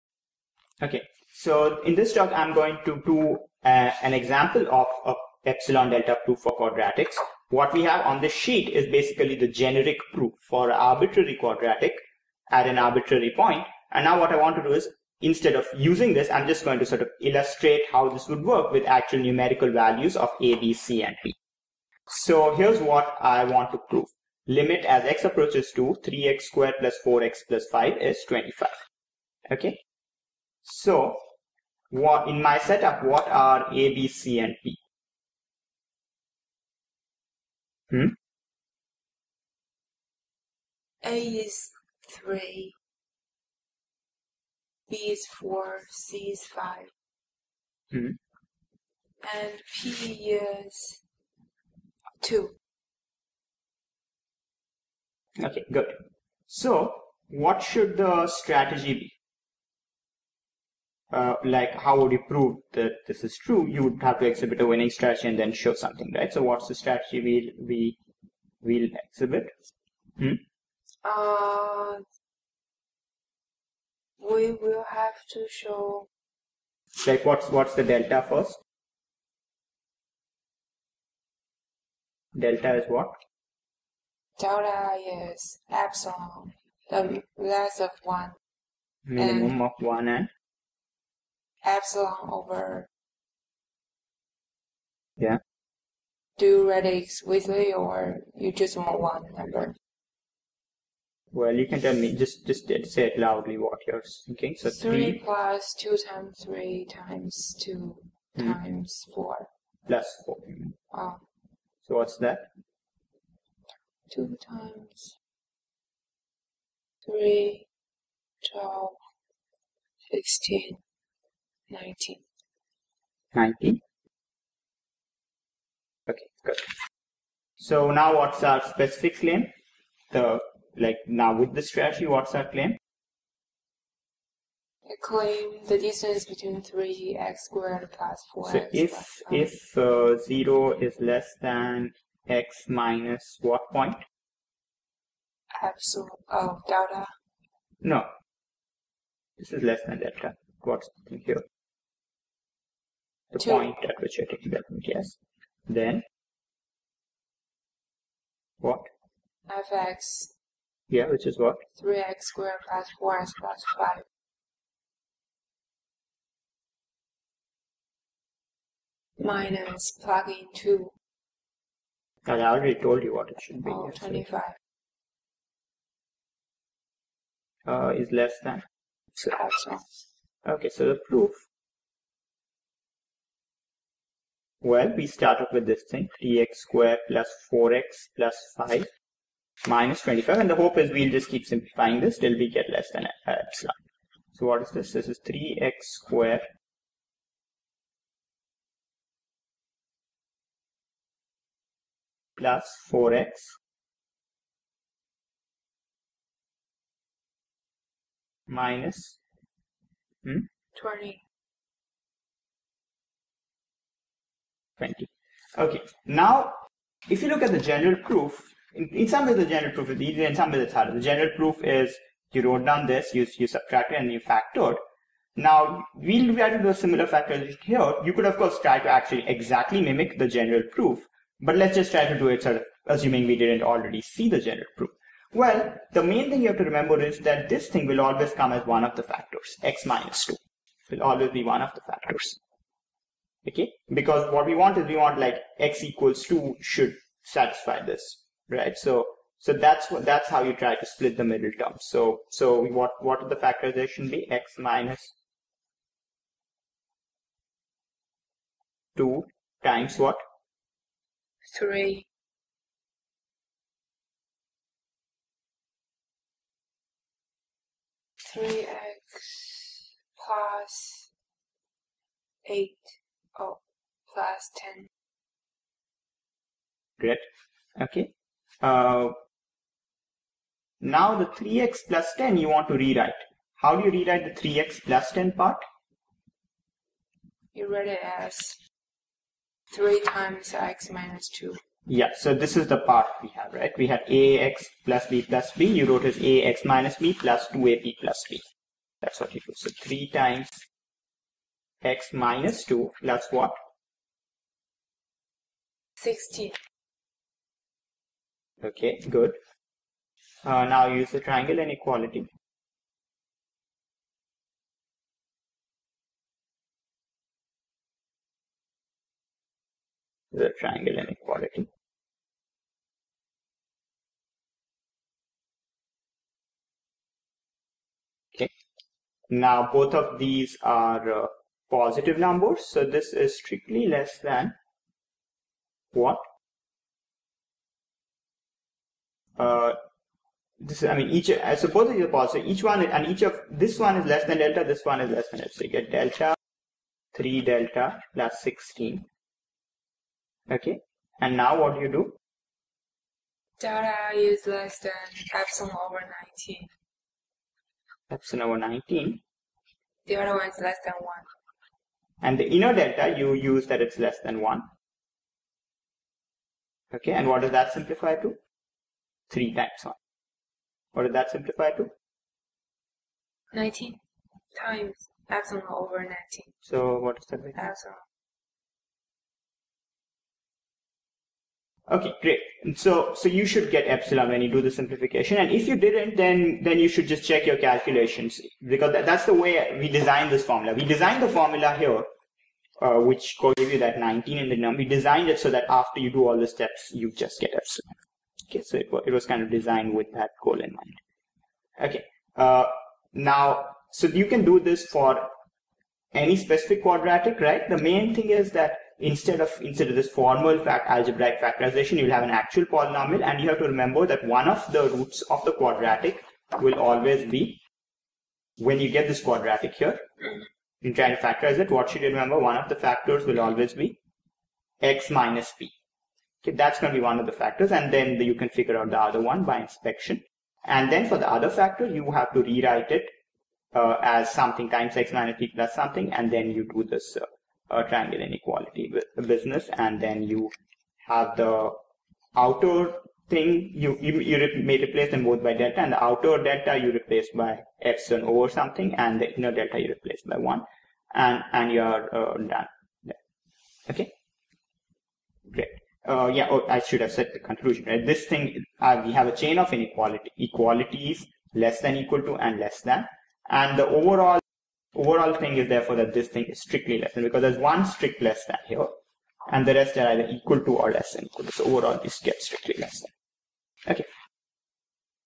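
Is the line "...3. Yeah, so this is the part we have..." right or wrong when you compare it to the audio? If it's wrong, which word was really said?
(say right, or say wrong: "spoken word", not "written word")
wrong: "2", not "3".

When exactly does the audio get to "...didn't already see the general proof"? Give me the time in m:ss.
3:53.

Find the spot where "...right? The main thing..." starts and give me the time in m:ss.
6:47.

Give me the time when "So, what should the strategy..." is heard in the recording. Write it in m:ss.
0:56.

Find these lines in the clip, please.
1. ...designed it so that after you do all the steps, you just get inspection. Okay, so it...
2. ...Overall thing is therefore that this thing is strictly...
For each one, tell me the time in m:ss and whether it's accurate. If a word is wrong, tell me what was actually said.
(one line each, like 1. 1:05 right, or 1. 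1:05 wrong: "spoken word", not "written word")
1. 6:34 wrong: "epsilon", not "inspection"
2. 7:44 right.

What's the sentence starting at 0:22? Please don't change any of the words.
So here's what I want to prove.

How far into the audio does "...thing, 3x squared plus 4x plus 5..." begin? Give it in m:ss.
3:05.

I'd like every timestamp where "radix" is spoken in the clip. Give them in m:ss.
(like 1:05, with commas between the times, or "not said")
1:36.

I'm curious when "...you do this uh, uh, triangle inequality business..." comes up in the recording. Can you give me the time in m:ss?
7:16.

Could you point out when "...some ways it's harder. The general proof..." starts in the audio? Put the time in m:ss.
3:40.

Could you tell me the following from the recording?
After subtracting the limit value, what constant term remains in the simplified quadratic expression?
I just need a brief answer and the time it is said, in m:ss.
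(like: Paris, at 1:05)
20, at 3:30.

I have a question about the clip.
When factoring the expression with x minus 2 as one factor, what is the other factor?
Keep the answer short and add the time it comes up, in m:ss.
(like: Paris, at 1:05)
3x plus 10, at 4:33.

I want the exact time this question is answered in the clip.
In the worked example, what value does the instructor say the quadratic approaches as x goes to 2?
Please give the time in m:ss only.
0:27.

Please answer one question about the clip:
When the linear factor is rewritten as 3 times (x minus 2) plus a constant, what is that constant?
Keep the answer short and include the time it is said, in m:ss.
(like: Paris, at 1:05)
16, at 5:05.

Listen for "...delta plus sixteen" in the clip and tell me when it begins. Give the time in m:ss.
5:47.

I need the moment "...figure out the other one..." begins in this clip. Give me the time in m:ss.
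7:08.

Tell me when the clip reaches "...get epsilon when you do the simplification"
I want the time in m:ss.
6:23.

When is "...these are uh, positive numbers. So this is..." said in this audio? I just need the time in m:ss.
5:30.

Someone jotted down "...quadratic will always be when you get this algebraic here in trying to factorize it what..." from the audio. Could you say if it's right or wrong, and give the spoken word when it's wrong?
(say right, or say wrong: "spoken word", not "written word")
wrong: "quadratic", not "algebraic".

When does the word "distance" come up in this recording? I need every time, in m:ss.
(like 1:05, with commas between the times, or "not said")
2:15.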